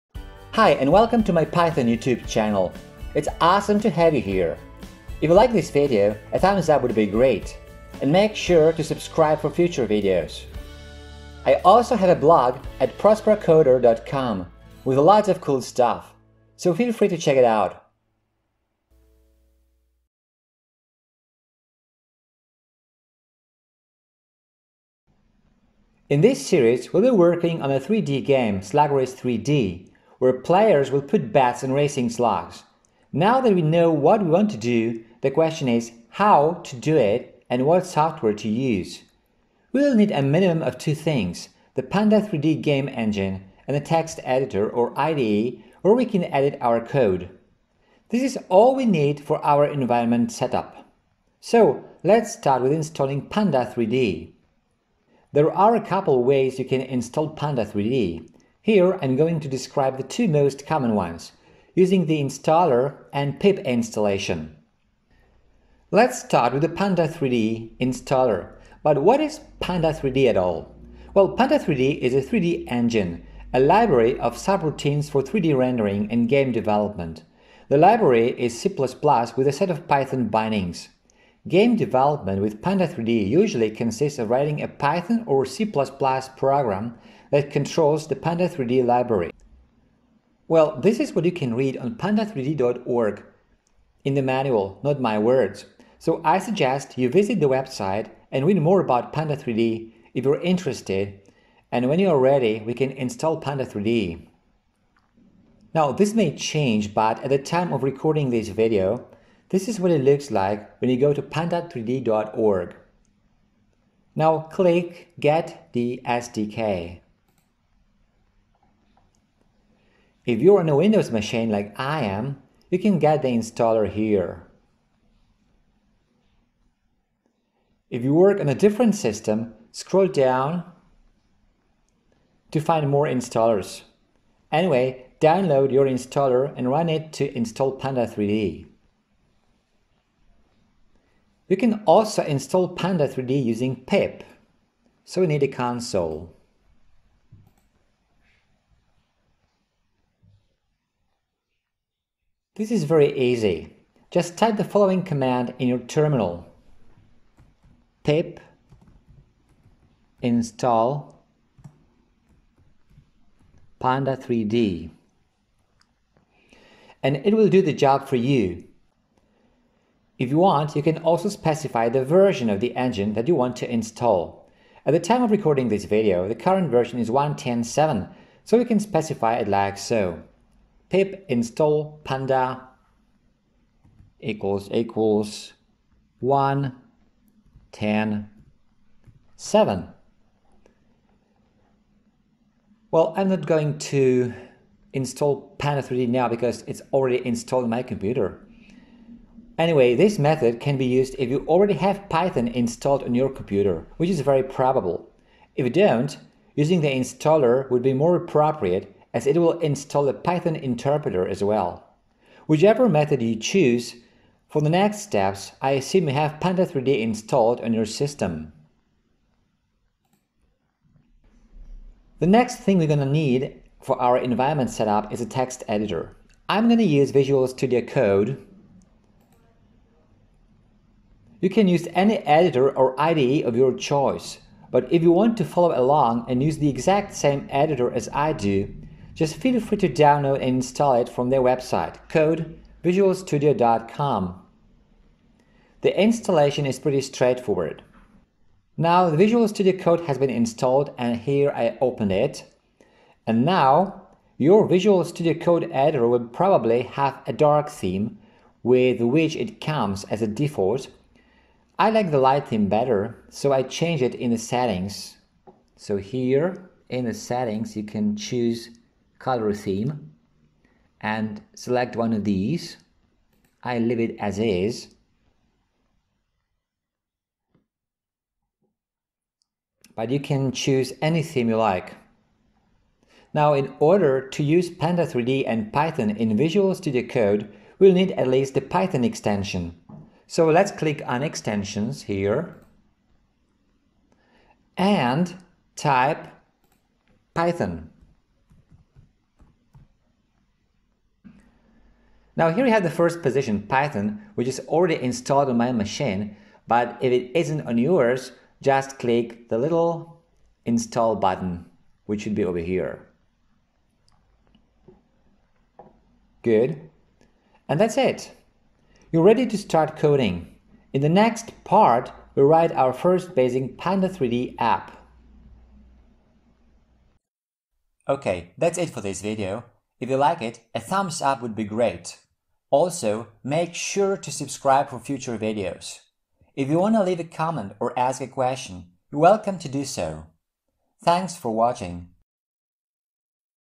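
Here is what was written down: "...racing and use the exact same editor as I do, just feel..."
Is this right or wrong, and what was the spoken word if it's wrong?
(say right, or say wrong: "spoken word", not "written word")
wrong: "along", not "racing".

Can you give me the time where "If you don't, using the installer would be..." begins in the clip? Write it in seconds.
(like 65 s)
205 s.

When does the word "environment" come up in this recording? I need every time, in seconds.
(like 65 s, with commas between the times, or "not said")
49 s, 224 s.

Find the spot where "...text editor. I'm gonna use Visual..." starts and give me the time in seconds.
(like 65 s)
225 s.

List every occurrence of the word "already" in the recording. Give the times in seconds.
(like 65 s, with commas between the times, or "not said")
196 s, 201 s, 304 s.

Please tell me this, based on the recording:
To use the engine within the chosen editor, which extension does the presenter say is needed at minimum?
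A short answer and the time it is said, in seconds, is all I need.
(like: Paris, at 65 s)
Python extension, at 288 s.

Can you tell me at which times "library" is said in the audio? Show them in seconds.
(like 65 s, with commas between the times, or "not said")
73 s, 77 s, 88 s.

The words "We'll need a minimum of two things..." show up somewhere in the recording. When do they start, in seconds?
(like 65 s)
39 s.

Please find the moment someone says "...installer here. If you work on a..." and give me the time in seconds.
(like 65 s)
123 s.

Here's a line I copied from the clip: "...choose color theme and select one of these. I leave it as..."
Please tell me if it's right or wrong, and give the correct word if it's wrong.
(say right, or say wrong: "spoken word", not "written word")
right.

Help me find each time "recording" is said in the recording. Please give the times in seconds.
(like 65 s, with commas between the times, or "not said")
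107 s, 175 s.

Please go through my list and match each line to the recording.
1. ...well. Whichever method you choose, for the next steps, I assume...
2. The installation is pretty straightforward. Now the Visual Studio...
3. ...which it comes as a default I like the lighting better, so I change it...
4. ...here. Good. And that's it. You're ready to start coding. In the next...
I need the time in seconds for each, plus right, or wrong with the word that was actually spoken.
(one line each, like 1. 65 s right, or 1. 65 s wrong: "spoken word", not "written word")
1. 211 s right
2. 245 s right
3. 259 s right
4. 312 s right.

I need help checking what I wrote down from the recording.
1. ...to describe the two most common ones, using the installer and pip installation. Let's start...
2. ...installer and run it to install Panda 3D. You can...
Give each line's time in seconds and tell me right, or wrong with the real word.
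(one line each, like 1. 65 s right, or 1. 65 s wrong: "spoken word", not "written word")
1. 59 s right
2. 135 s right.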